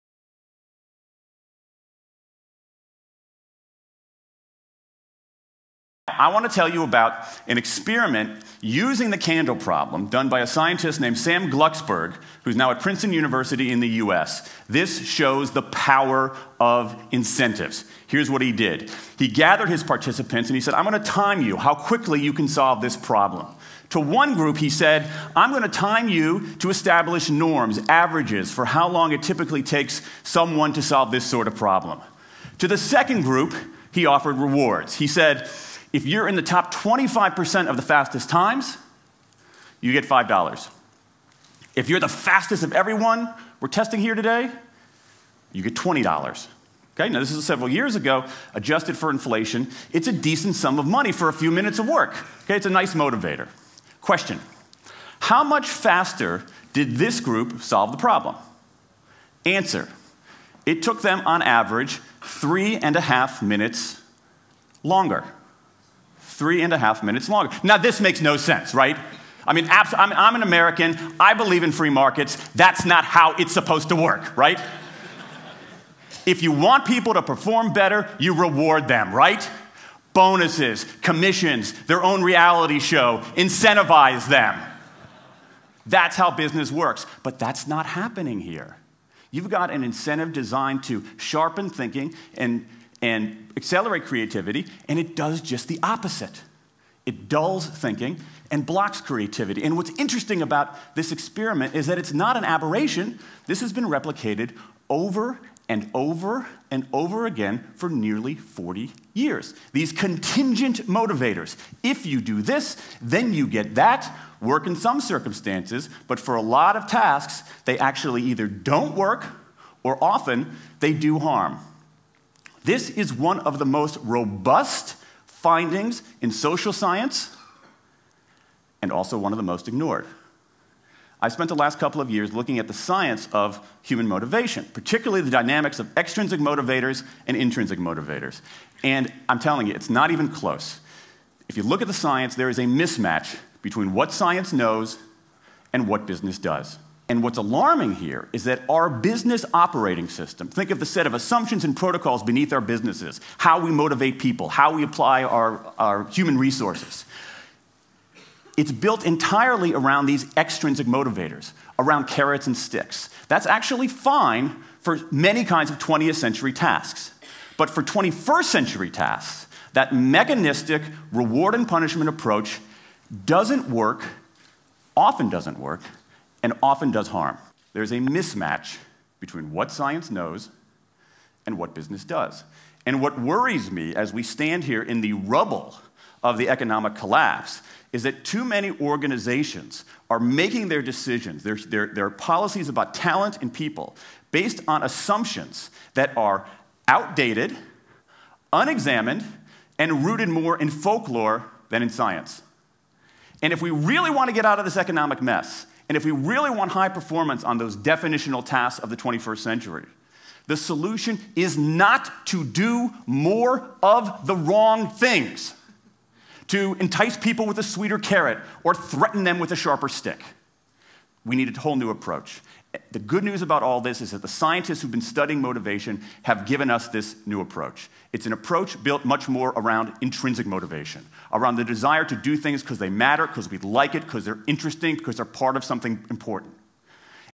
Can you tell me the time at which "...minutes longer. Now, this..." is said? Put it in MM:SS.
01:07.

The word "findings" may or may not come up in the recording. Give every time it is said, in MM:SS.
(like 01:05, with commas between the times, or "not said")
02:05.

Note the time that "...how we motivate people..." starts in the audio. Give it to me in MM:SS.
02:33.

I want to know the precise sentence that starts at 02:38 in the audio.
It's built entirely around these extrinsic motivators, around carrots and sticks.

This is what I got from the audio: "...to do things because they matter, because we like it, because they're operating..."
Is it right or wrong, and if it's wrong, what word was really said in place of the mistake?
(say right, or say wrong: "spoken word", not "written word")
wrong: "interesting", not "operating".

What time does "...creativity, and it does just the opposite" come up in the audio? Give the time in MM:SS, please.
01:34.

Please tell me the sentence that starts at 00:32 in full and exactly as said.
To the second group, he offered rewards.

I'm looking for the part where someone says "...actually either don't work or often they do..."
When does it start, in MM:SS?
01:57.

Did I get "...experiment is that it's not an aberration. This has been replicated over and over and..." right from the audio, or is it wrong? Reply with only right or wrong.
right.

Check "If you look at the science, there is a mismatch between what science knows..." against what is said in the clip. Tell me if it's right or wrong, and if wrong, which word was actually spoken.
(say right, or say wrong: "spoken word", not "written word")
right.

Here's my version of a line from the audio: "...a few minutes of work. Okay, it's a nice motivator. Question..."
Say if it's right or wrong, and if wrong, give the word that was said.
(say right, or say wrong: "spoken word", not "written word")
right.